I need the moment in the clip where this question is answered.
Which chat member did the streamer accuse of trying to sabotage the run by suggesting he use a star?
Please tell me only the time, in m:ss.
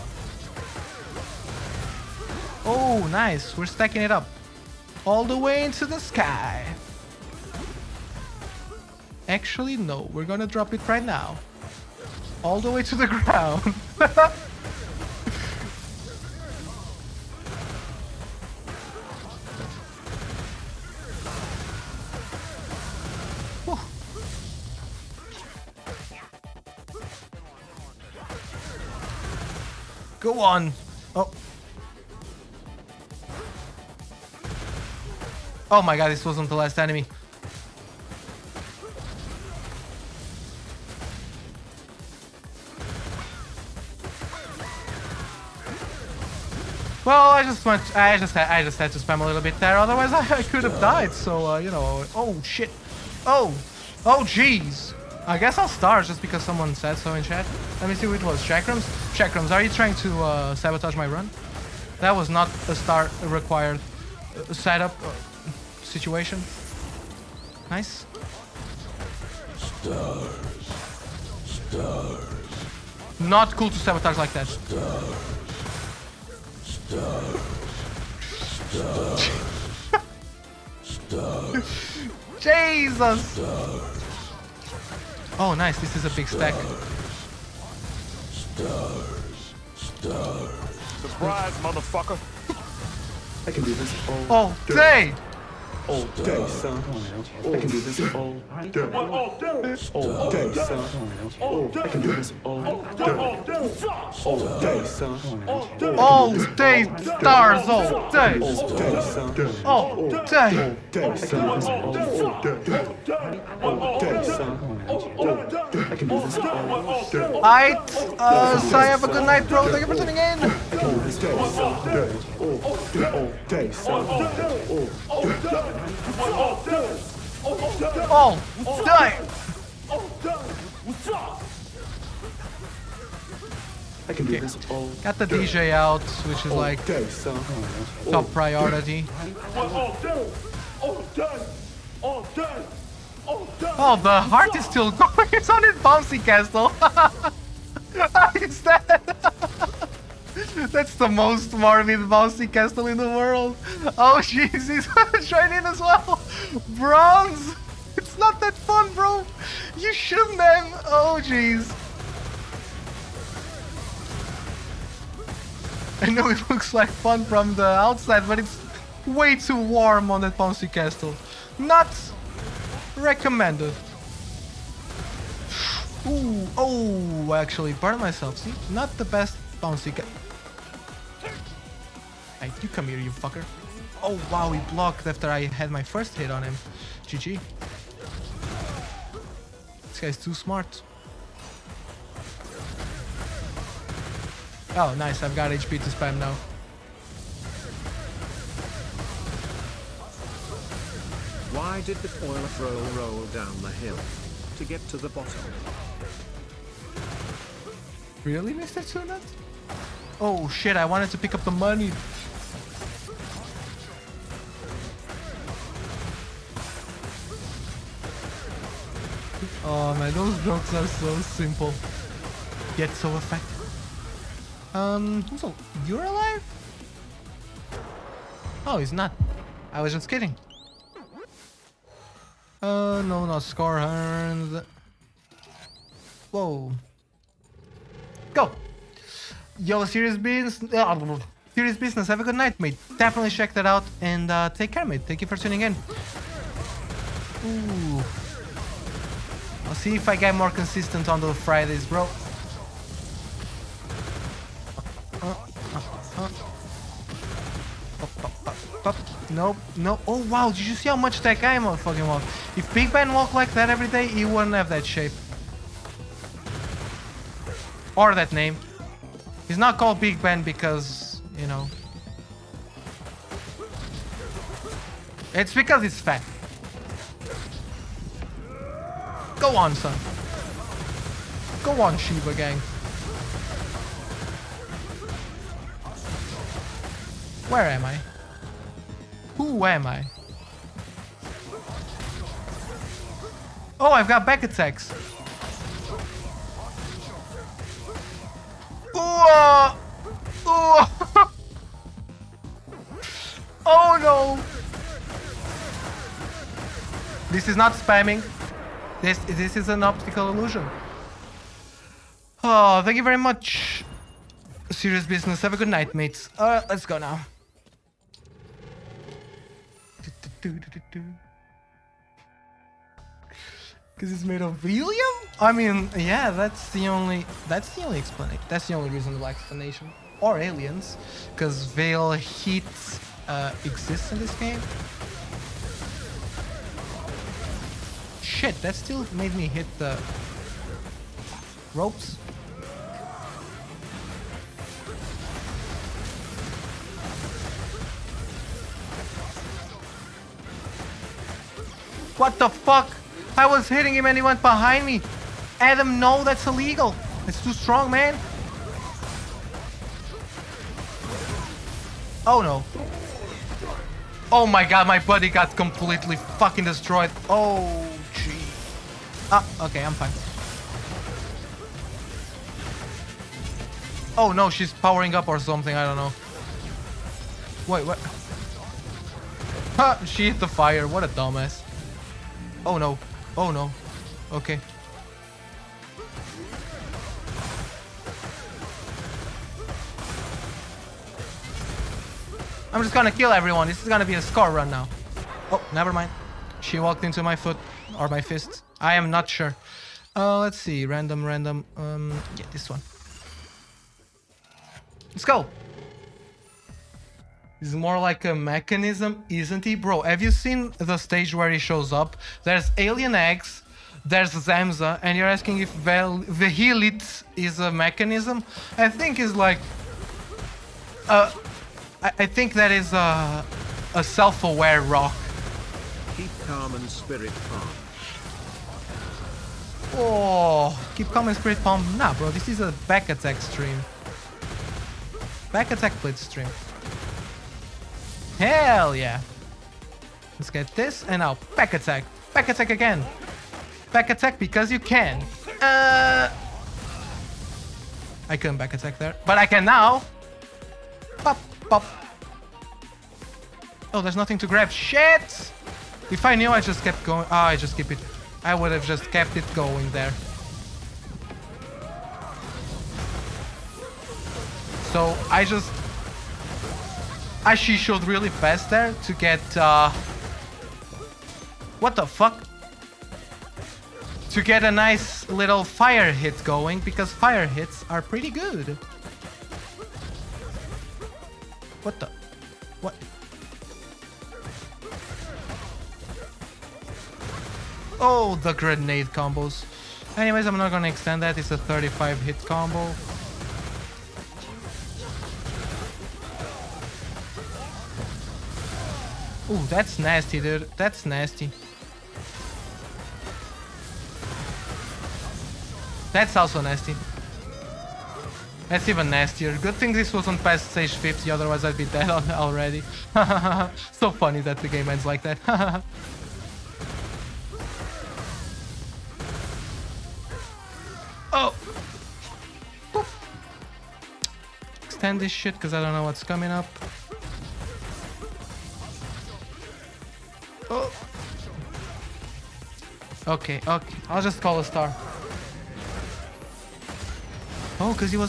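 0:59.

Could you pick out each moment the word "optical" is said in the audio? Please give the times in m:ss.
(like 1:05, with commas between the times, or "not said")
5:09.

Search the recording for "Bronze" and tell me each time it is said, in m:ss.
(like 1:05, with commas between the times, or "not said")
2:36.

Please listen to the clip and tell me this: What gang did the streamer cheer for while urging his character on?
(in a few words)
Shiva gang.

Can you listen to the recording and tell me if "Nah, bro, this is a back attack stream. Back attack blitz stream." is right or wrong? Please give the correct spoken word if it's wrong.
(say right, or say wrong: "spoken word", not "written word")
right.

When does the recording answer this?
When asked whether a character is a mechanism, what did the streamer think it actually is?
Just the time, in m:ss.
7:04.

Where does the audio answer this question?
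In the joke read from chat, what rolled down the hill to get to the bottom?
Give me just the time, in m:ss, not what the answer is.
3:21.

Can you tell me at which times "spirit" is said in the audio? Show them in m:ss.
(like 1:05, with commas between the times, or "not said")
7:06, 7:11.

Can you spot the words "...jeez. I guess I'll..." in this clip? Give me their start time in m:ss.
0:54.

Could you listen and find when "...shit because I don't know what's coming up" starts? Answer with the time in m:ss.
8:45.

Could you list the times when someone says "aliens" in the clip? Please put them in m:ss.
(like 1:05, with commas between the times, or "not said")
5:30, 6:52.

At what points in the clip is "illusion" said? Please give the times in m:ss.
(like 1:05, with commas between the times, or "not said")
5:10.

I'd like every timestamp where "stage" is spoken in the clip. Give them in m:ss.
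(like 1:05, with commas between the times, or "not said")
6:50, 8:30.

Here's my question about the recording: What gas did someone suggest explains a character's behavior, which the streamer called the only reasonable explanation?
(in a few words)
Helium.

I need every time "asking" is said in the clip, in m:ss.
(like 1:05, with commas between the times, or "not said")
6:55.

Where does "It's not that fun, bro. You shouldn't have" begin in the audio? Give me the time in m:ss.
2:37.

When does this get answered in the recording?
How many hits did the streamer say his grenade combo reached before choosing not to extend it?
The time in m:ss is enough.
8:11.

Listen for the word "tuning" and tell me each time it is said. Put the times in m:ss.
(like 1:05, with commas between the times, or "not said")
1:59, 4:05.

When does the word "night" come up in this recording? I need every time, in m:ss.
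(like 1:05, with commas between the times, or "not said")
1:59, 4:02, 5:15.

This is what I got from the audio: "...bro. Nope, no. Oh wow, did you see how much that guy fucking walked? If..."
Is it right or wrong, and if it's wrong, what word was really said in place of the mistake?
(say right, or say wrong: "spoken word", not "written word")
right.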